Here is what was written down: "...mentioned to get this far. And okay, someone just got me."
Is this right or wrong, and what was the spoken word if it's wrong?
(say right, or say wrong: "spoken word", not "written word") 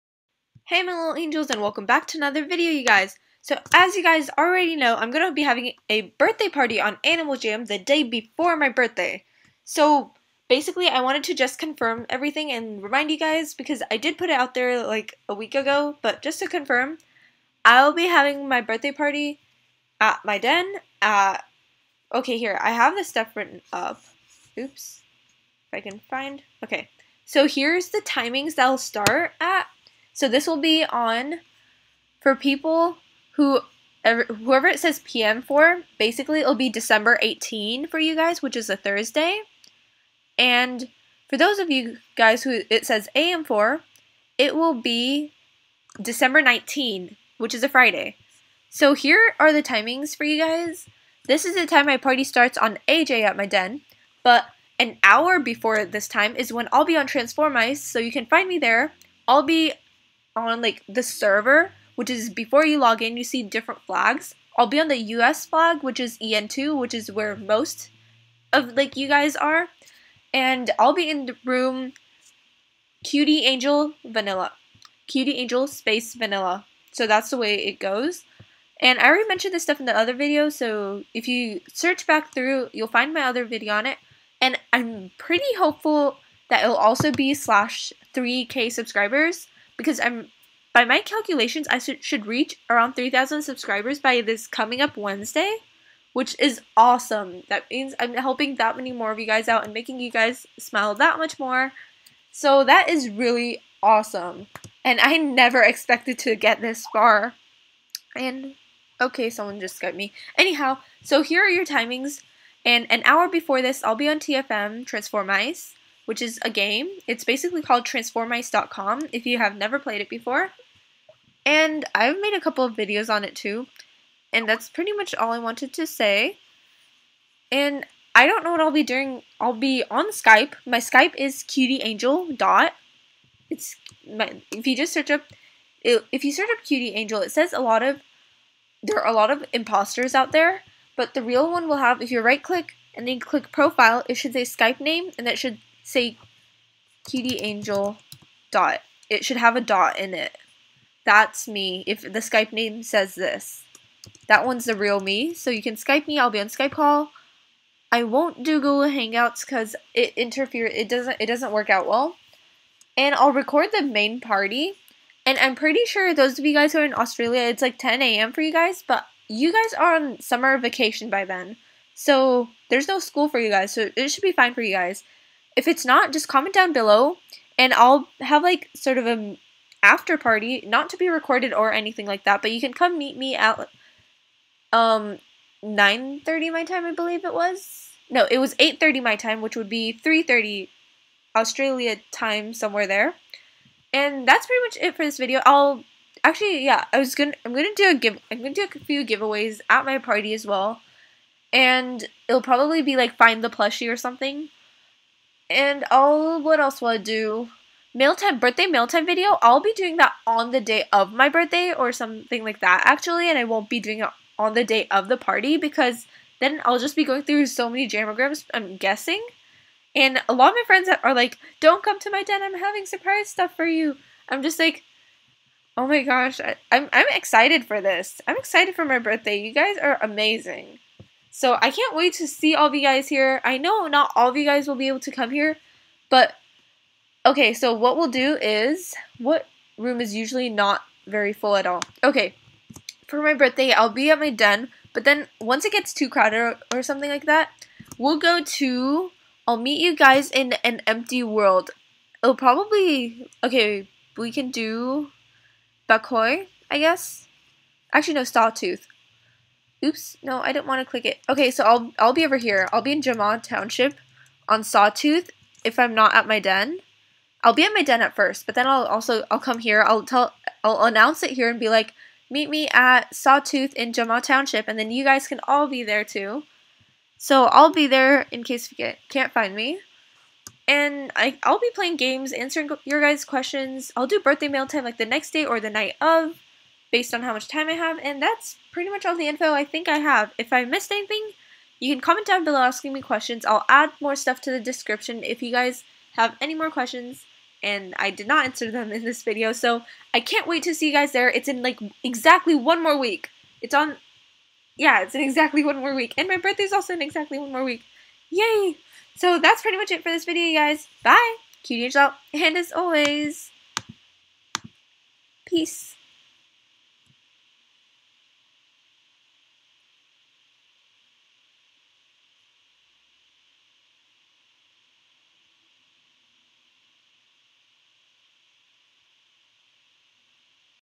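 wrong: "expected", not "mentioned".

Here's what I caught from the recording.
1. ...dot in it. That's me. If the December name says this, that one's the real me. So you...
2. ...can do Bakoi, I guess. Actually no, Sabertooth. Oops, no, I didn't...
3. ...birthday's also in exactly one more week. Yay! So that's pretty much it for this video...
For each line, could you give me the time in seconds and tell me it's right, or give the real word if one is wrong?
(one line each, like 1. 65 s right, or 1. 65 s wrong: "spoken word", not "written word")
1. 149 s wrong: "Skype", not "December"
2. 254 s right
3. 306 s right.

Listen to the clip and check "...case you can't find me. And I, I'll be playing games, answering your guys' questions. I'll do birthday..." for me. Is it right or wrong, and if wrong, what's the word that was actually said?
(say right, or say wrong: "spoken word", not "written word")
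right.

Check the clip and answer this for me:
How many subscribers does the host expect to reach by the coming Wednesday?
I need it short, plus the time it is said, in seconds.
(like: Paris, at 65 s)
3000, at 92 s.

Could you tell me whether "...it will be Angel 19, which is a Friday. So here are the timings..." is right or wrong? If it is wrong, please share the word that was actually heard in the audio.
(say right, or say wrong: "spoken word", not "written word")
wrong: "December", not "Angel".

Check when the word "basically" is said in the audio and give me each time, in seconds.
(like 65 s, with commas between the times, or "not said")
10 s, 35 s, 117 s.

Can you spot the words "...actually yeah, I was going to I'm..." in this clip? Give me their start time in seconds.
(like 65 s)
196 s.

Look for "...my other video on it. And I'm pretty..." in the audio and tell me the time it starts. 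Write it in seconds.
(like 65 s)
83 s.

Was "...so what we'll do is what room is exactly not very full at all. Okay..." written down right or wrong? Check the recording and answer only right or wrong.
wrong.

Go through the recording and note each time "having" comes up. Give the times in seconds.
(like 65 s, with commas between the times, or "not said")
5 s, 18 s, 222 s.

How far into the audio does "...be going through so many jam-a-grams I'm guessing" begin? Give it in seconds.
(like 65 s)
216 s.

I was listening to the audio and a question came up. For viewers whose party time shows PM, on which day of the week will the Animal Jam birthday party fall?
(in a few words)
Thursday.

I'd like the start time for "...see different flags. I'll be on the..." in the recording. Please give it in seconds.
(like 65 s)
63 s.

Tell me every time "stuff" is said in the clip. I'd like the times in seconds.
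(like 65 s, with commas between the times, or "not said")
23 s, 79 s, 223 s, 294 s.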